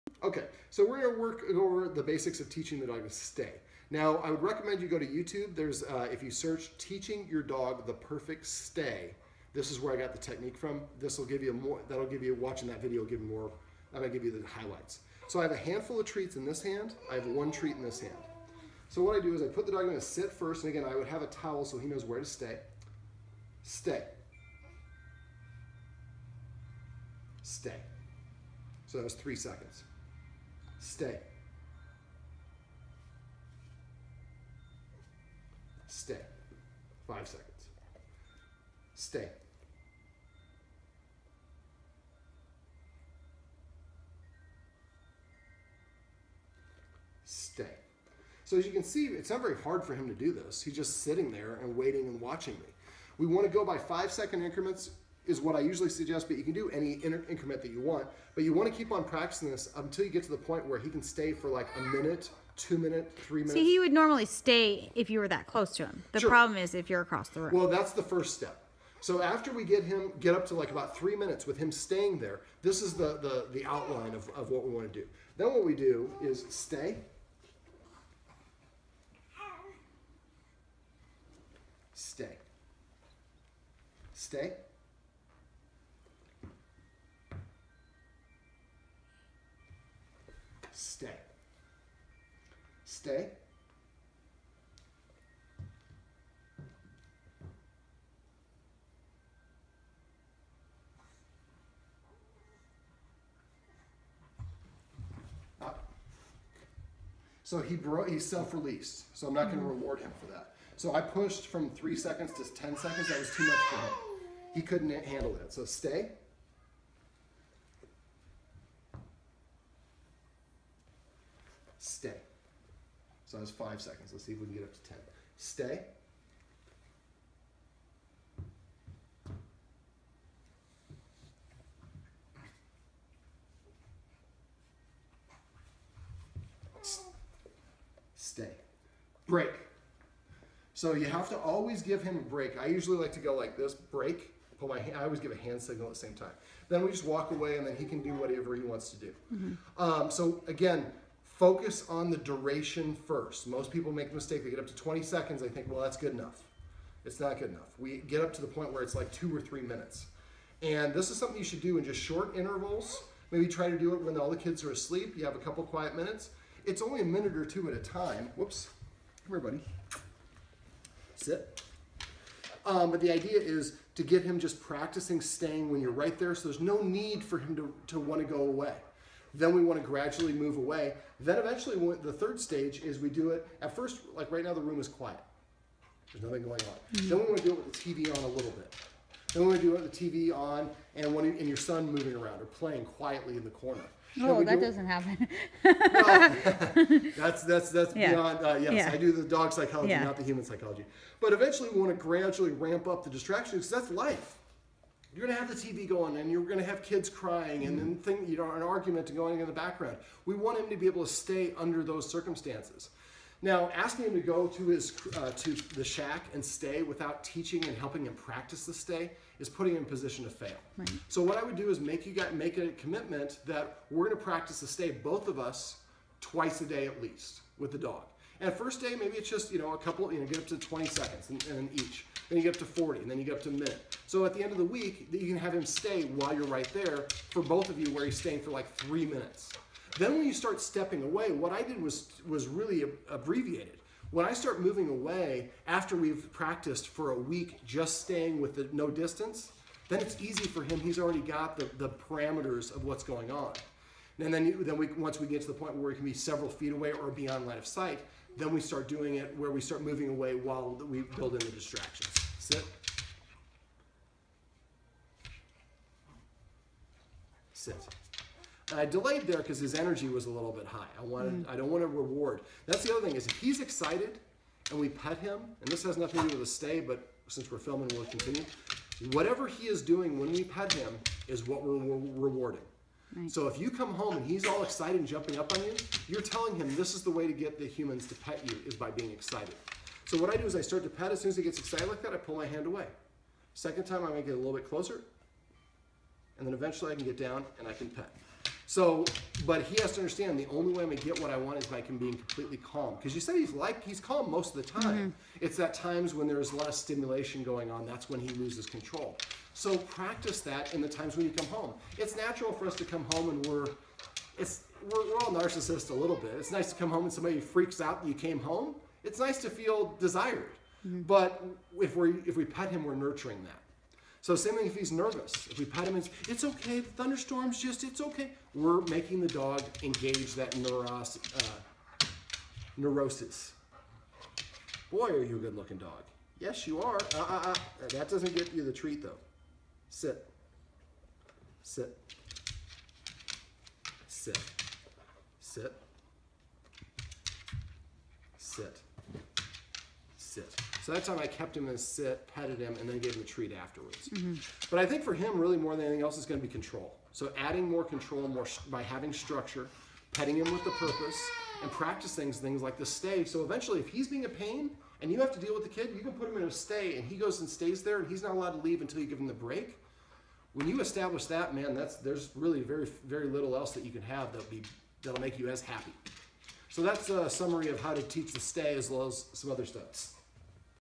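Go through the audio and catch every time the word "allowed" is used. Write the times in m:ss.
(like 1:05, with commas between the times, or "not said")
6:08.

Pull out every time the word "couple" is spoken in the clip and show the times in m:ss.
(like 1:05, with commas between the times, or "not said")
2:45, 3:49.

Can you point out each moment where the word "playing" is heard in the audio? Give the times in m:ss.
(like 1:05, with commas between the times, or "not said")
3:12.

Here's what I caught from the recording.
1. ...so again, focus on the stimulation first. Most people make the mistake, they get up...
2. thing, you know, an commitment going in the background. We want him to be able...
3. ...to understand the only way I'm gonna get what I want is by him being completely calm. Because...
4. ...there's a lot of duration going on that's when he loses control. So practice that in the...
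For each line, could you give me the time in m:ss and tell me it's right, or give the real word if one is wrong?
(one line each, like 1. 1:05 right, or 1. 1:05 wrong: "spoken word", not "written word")
1. 2:30 wrong: "duration", not "stimulation"
2. 3:28 wrong: "argument", not "commitment"
3. 4:59 right
4. 5:06 wrong: "stimulation", not "duration".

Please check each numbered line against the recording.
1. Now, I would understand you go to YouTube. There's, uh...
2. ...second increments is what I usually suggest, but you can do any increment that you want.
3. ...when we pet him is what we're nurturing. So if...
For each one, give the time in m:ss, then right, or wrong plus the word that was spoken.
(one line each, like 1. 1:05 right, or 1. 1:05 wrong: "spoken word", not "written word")
1. 0:03 wrong: "recommend", not "understand"
2. 0:54 right
3. 4:40 wrong: "rewarding", not "nurturing".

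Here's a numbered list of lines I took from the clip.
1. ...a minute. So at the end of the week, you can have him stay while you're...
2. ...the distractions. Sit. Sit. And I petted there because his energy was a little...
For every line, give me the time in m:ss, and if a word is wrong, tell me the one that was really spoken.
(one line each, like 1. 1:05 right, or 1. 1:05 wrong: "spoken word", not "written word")
1. 3:53 right
2. 4:21 wrong: "delayed", not "petted".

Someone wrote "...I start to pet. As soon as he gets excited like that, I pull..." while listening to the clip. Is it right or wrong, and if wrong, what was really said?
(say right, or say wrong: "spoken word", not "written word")
right.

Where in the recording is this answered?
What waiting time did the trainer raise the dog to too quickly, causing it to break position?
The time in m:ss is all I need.
1:52.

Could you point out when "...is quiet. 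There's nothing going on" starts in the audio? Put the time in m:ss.
3:04.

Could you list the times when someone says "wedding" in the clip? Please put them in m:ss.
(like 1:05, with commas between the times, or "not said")
not said.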